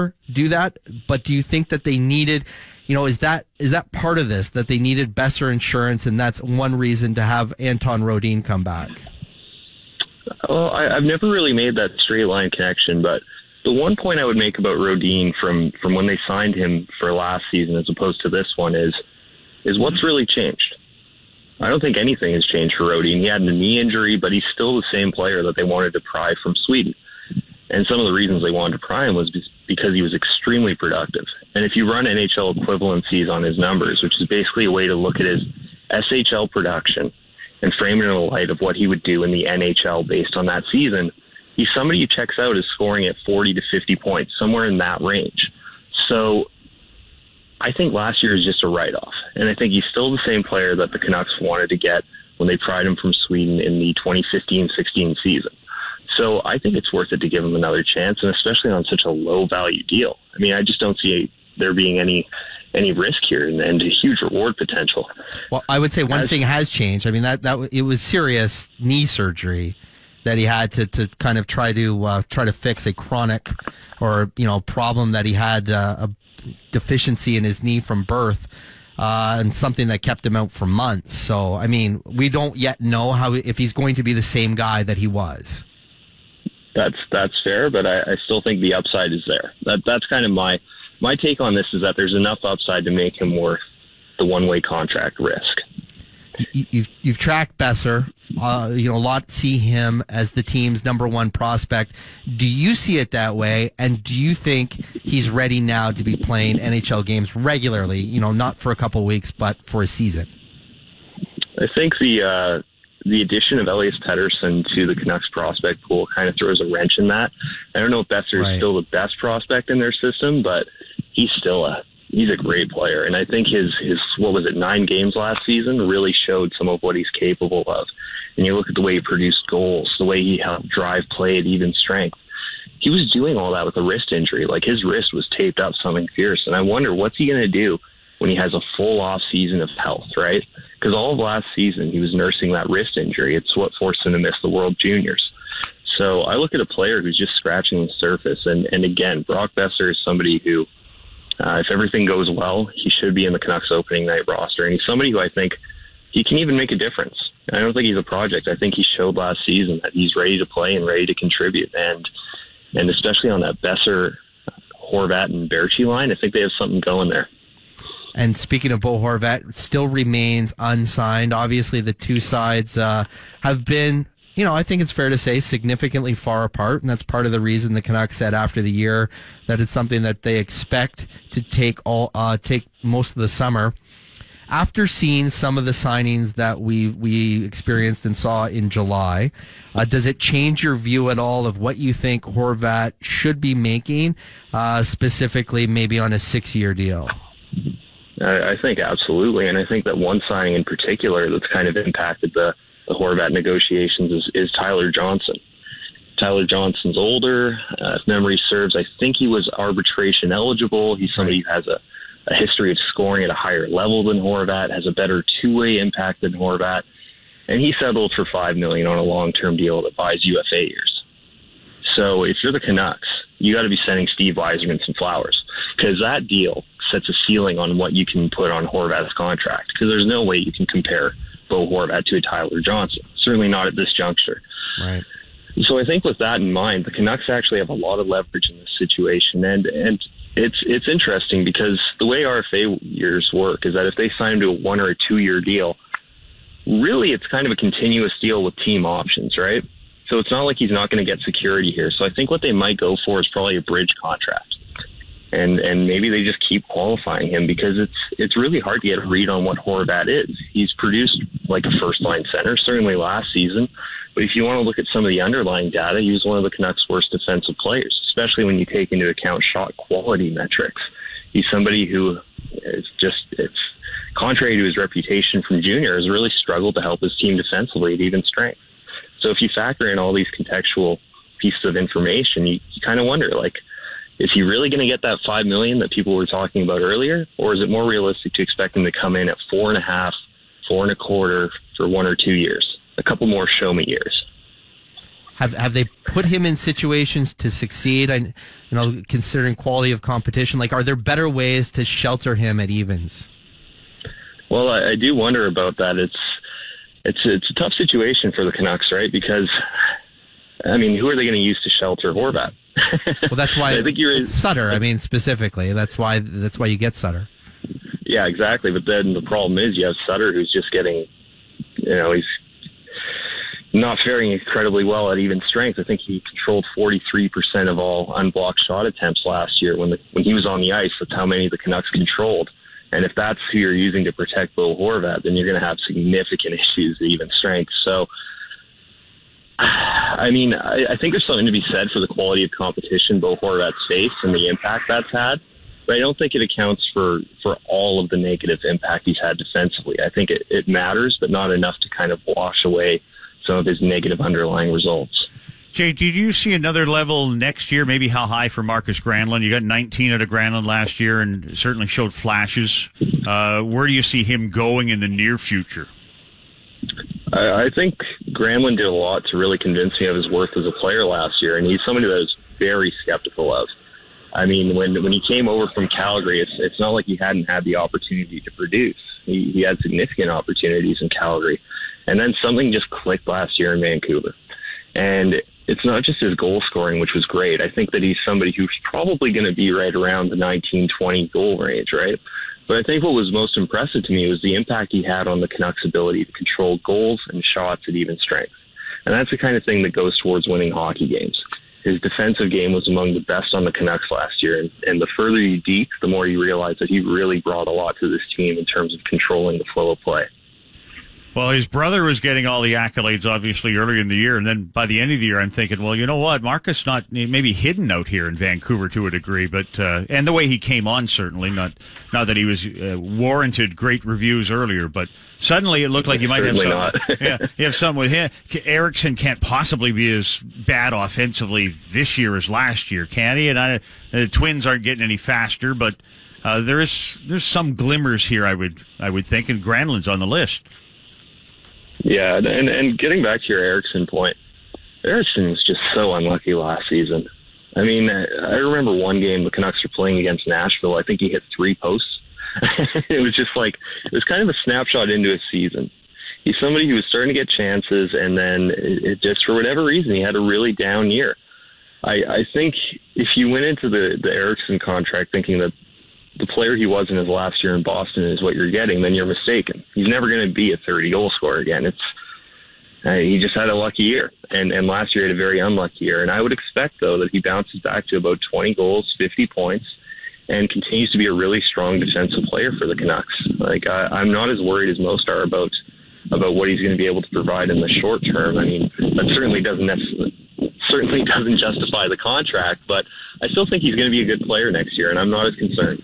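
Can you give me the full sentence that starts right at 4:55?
Have have they put him in situations to succeed?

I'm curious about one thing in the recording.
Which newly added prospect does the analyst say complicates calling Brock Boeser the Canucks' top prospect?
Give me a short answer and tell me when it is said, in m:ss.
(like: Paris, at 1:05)
Elias Pettersson, at 1:53.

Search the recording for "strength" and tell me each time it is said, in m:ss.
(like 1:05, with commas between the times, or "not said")
2:11, 4:38, 5:25, 5:37, 6:38.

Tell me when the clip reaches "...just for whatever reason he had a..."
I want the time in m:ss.
7:39.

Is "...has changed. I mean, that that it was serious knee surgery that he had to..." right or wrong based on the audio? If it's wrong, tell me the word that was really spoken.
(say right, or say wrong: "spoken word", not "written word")
right.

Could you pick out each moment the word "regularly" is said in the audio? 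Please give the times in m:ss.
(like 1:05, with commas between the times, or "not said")
1:47.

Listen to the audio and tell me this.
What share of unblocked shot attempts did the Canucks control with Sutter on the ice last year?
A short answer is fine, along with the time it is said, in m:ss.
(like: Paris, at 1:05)
43%, at 5:26.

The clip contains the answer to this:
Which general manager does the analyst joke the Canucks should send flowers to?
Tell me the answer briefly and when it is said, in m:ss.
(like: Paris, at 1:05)
Steve Yzerman, at 3:44.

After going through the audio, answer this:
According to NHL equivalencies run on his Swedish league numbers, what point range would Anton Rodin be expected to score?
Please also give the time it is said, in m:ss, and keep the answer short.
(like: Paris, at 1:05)
40 to 50 points, at 0:43.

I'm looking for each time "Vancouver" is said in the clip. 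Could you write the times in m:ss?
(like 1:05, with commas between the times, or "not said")
6:23, 6:58.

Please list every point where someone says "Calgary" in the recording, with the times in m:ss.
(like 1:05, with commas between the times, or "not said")
6:15, 6:21.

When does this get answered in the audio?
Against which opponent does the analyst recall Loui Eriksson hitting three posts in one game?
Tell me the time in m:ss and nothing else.
7:30.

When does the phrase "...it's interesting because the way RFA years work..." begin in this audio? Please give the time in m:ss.
4:00.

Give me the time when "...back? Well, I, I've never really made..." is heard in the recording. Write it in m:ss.
0:08.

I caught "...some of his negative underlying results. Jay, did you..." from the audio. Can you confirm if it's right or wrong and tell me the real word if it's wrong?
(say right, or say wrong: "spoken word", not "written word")
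right.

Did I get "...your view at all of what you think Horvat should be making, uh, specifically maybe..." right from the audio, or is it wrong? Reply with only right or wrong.
right.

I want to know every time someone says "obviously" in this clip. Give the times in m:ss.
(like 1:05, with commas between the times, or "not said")
2:51, 6:53.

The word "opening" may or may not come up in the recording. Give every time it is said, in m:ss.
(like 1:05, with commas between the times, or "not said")
2:33.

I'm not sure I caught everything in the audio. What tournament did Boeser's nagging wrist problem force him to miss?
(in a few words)
World Juniors.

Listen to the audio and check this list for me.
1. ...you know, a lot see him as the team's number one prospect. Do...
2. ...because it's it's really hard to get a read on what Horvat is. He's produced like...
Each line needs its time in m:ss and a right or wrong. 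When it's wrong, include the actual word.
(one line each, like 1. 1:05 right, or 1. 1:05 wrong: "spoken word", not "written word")
1. 1:38 right
2. 4:17 right.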